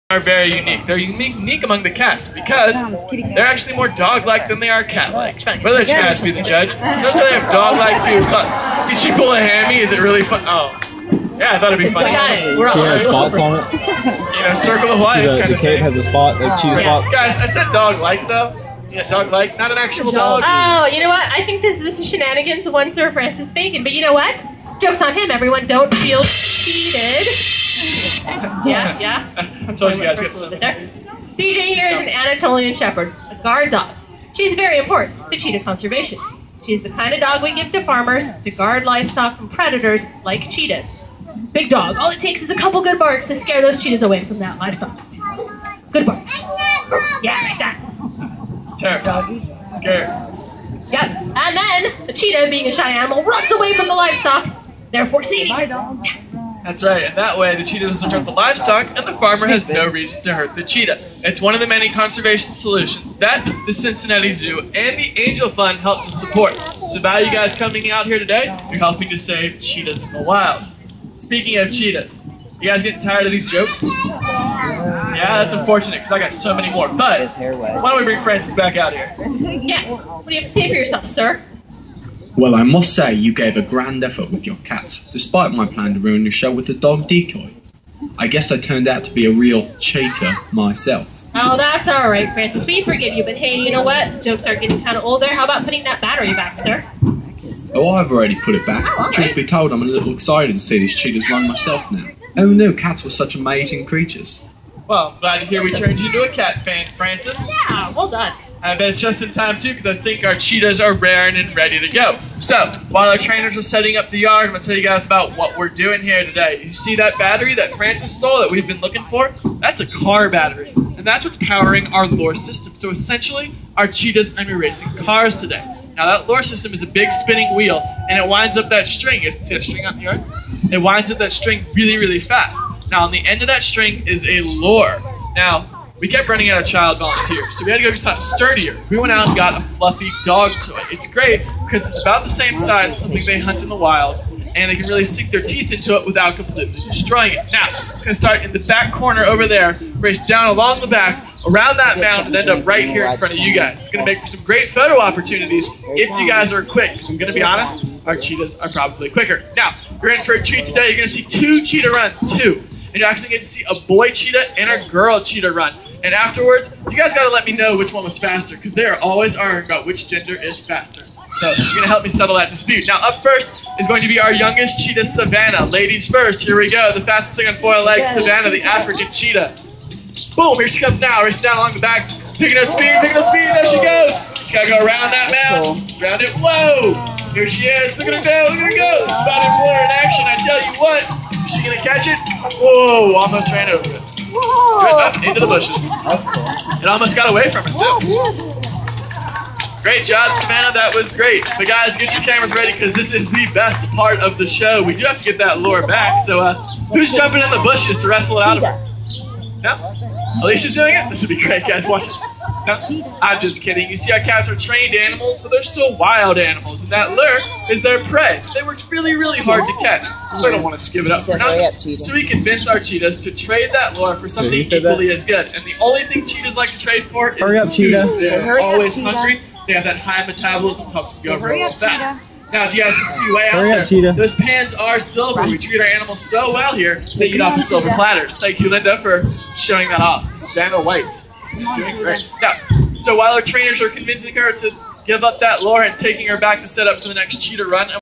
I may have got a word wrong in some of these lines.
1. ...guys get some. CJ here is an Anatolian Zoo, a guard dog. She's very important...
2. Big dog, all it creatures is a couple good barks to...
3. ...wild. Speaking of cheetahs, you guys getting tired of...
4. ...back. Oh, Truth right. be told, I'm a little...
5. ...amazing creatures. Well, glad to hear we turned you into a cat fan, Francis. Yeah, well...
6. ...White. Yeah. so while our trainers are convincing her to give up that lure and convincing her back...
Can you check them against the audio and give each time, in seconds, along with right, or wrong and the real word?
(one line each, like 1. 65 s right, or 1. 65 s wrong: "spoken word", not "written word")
1. 30 s wrong: "Shepherd", not "Zoo"
2. 41 s wrong: "takes", not "creatures"
3. 70 s right
4. 98 s right
5. 103 s right
6. 240 s wrong: "taking", not "convincing".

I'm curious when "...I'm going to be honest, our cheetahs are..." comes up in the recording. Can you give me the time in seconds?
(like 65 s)
157 s.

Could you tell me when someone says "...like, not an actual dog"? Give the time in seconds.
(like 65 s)
19 s.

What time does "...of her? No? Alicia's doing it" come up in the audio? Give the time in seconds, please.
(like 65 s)
208 s.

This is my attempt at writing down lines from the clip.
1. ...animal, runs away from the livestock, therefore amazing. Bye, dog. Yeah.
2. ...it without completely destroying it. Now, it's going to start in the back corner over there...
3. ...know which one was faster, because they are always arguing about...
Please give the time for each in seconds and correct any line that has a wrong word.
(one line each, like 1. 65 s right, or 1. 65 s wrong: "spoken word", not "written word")
1. 52 s wrong: "seeding", not "amazing"
2. 145 s right
3. 167 s right.